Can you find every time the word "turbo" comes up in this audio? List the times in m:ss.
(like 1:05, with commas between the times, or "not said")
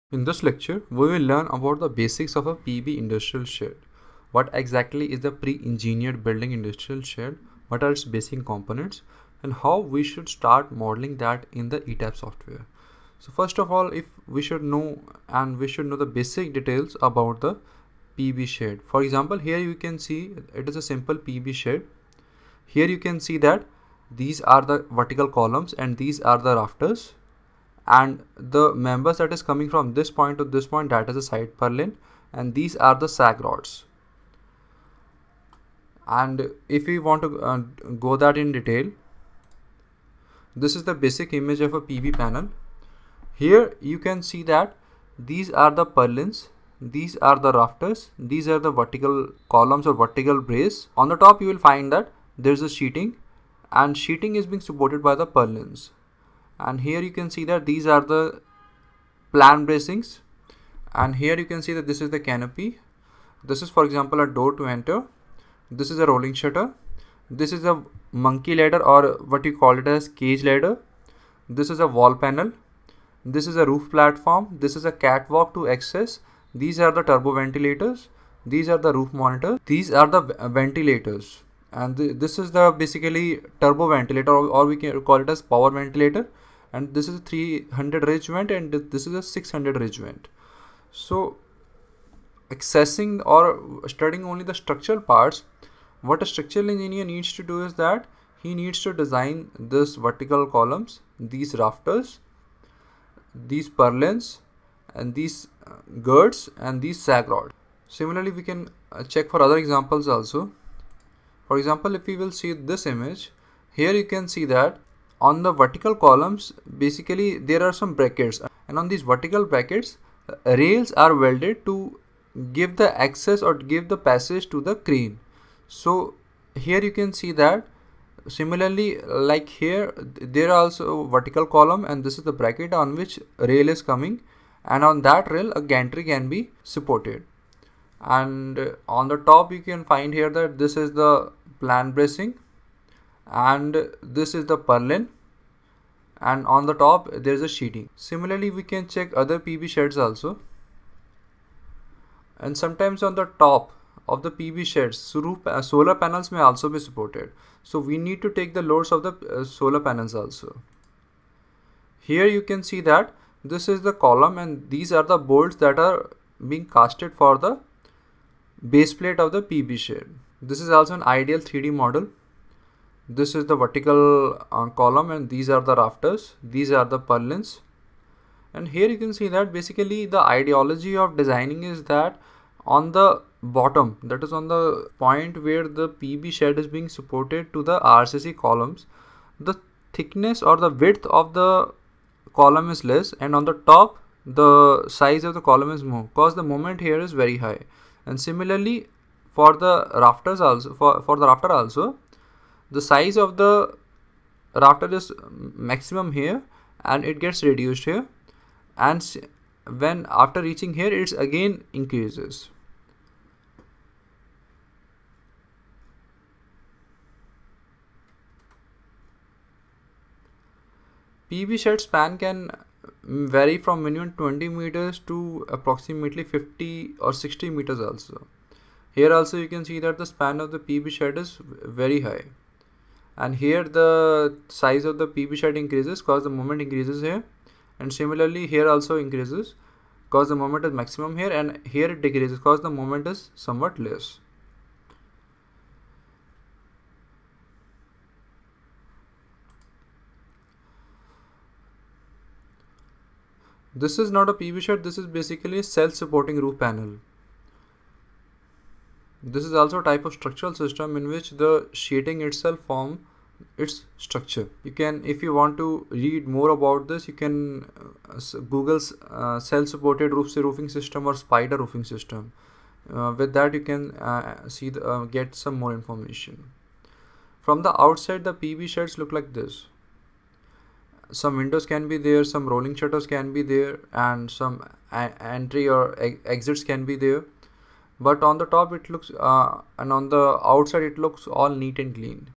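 1:17, 1:23.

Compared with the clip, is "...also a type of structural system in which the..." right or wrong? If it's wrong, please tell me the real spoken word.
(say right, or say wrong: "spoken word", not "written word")
right.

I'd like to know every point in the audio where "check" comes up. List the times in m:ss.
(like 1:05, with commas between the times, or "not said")
1:49, 2:28.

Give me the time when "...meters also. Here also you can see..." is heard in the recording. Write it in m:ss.
3:47.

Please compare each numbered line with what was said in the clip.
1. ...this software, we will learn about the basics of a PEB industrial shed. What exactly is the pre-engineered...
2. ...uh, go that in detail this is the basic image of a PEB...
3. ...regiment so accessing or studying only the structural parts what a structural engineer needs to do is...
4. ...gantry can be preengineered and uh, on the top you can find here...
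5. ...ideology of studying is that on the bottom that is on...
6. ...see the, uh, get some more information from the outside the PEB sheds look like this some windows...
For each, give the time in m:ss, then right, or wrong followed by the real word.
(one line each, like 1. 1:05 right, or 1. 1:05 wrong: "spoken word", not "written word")
1. 0:00 wrong: "lecture", not "software"
2. 0:37 right
3. 1:29 right
4. 2:15 wrong: "supported", not "preengineered"
5. 3:00 wrong: "designing", not "studying"
6. 4:34 right.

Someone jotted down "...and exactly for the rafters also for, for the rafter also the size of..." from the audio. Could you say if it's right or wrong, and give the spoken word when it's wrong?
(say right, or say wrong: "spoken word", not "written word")
wrong: "similarly", not "exactly".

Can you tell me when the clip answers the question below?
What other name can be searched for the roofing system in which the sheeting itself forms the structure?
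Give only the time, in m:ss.
4:31.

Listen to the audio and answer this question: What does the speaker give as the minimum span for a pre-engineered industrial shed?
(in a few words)
20 meters.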